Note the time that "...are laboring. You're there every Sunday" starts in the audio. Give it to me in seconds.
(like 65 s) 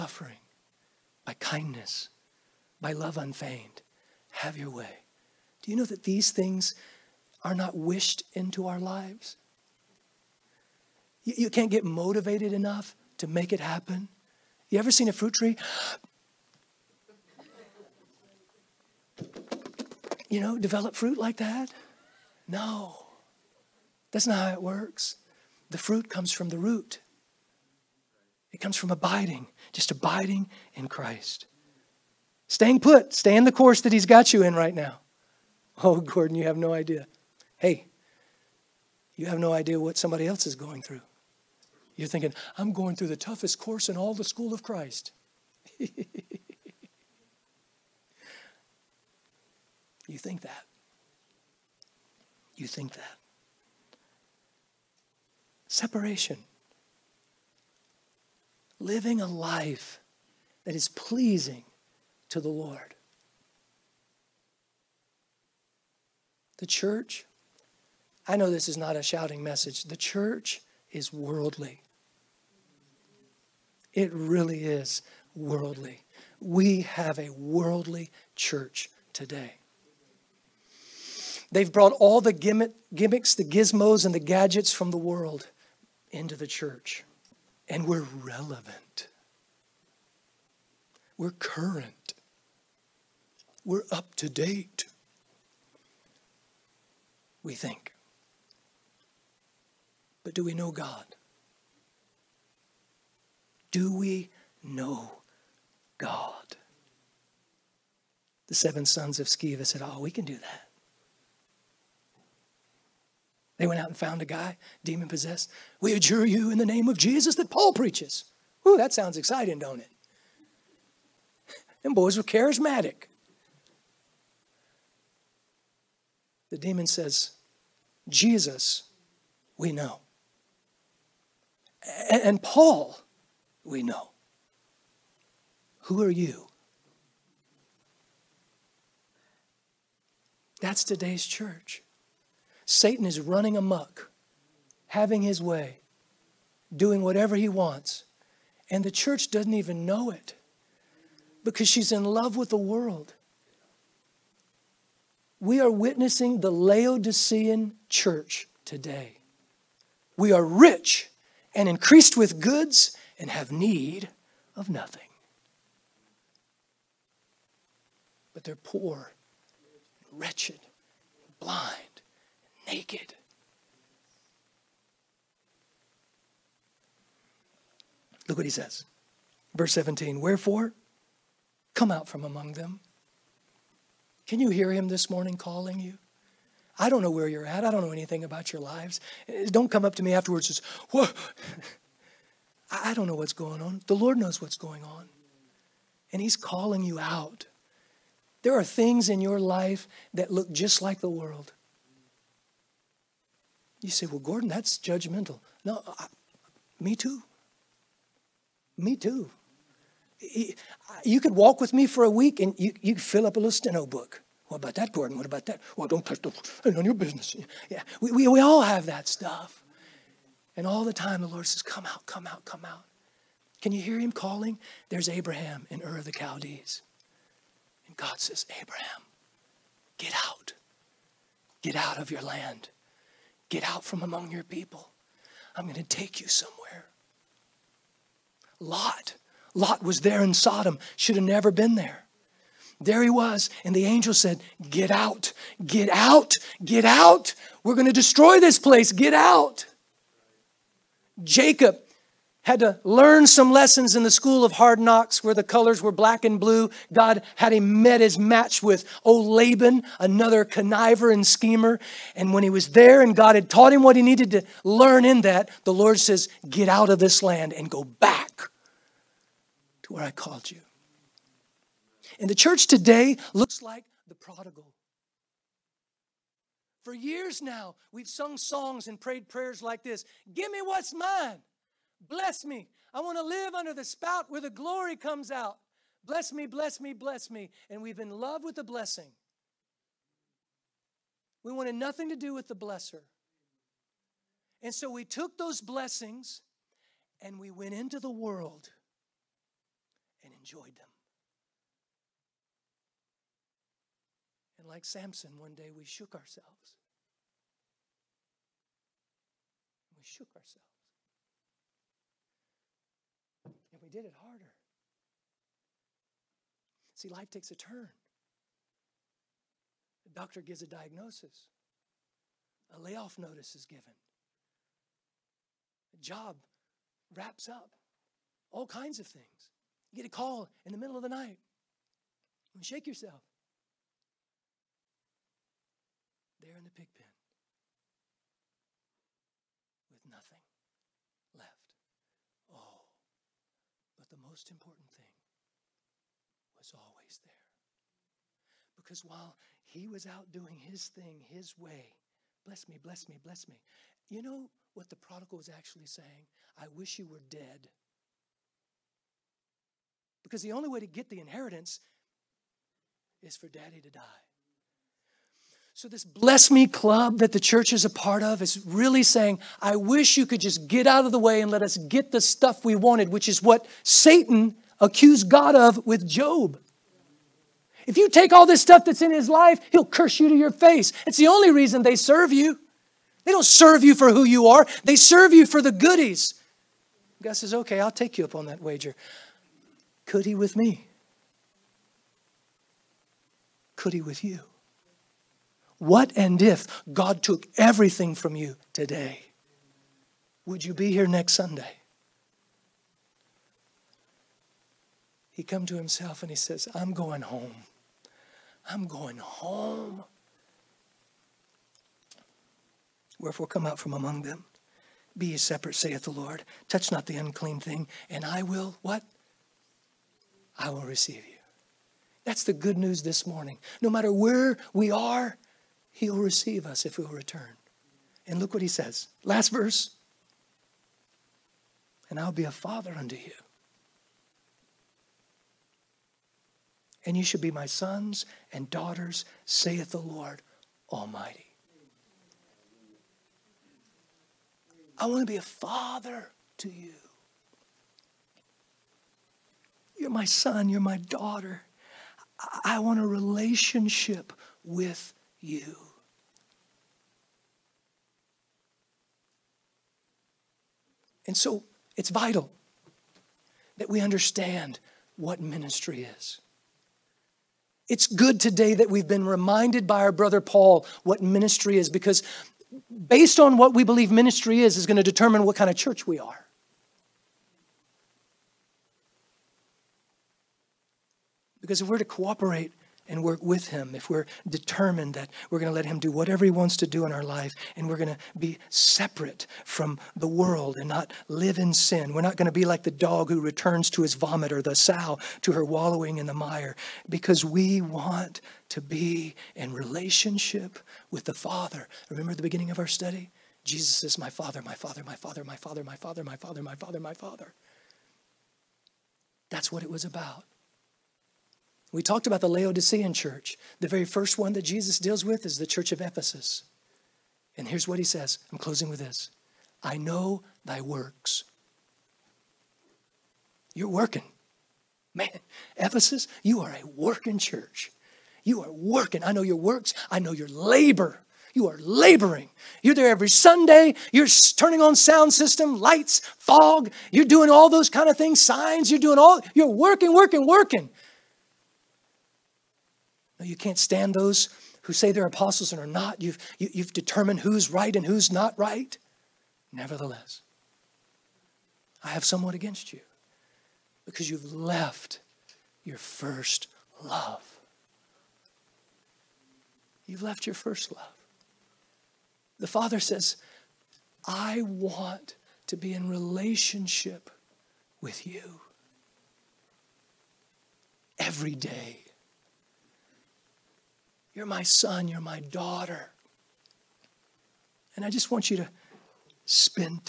531 s.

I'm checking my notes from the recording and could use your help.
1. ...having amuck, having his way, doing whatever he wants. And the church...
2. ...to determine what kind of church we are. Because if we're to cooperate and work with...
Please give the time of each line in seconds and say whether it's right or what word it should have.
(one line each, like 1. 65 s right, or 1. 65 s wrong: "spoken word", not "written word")
1. 143 s wrong: "running", not "having"
2. 474 s right.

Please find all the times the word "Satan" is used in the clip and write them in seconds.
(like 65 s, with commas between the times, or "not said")
142 s, 373 s.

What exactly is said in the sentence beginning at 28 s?
It comes from abiding, just abiding in Christ.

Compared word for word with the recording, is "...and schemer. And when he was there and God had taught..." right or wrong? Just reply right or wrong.
right.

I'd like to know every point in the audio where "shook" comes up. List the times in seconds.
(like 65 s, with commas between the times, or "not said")
305 s, 310 s.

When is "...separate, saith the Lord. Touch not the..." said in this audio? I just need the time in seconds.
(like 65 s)
415 s.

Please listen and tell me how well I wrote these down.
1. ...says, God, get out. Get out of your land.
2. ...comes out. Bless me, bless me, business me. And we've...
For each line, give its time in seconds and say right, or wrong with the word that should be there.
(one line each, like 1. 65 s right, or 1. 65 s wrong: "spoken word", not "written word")
1. 228 s wrong: "Abraham", not "God"
2. 284 s wrong: "bless", not "business".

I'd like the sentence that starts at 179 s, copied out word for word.
Verse 17 Wherefore, come out from among them can you hear him this morning calling you?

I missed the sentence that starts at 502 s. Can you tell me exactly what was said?
Remember the beginning of our study?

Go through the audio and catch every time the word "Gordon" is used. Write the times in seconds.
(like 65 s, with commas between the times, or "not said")
36 s, 204 s, 214 s.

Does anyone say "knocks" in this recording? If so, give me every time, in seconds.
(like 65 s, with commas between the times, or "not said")
254 s.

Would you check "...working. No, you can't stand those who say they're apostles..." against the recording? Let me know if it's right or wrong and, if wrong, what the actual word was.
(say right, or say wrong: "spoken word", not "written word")
right.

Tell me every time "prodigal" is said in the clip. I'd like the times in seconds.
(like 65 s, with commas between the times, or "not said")
274 s, 354 s.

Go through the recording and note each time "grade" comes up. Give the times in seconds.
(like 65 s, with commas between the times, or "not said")
not said.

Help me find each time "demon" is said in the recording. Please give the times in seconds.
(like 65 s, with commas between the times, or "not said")
114 s, 126 s.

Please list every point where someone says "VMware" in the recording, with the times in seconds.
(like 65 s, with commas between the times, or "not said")
not said.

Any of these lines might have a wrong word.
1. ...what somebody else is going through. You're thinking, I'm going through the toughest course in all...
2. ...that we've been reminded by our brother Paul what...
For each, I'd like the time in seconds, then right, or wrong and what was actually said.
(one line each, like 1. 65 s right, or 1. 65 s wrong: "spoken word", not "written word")
1. 39 s right
2. 468 s right.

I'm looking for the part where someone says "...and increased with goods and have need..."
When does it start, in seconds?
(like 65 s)
161 s.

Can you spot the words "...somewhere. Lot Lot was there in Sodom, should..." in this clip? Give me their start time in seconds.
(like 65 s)
236 s.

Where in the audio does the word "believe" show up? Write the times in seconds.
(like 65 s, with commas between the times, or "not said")
473 s.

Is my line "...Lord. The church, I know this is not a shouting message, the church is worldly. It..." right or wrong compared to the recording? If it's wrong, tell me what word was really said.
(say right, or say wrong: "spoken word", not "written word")
right.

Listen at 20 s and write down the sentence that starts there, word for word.
You know, develop fruit like that?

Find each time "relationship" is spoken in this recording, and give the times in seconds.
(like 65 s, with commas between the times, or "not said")
453 s, 499 s, 566 s.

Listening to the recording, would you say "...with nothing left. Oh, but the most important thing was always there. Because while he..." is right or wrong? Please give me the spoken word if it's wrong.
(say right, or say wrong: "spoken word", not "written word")
right.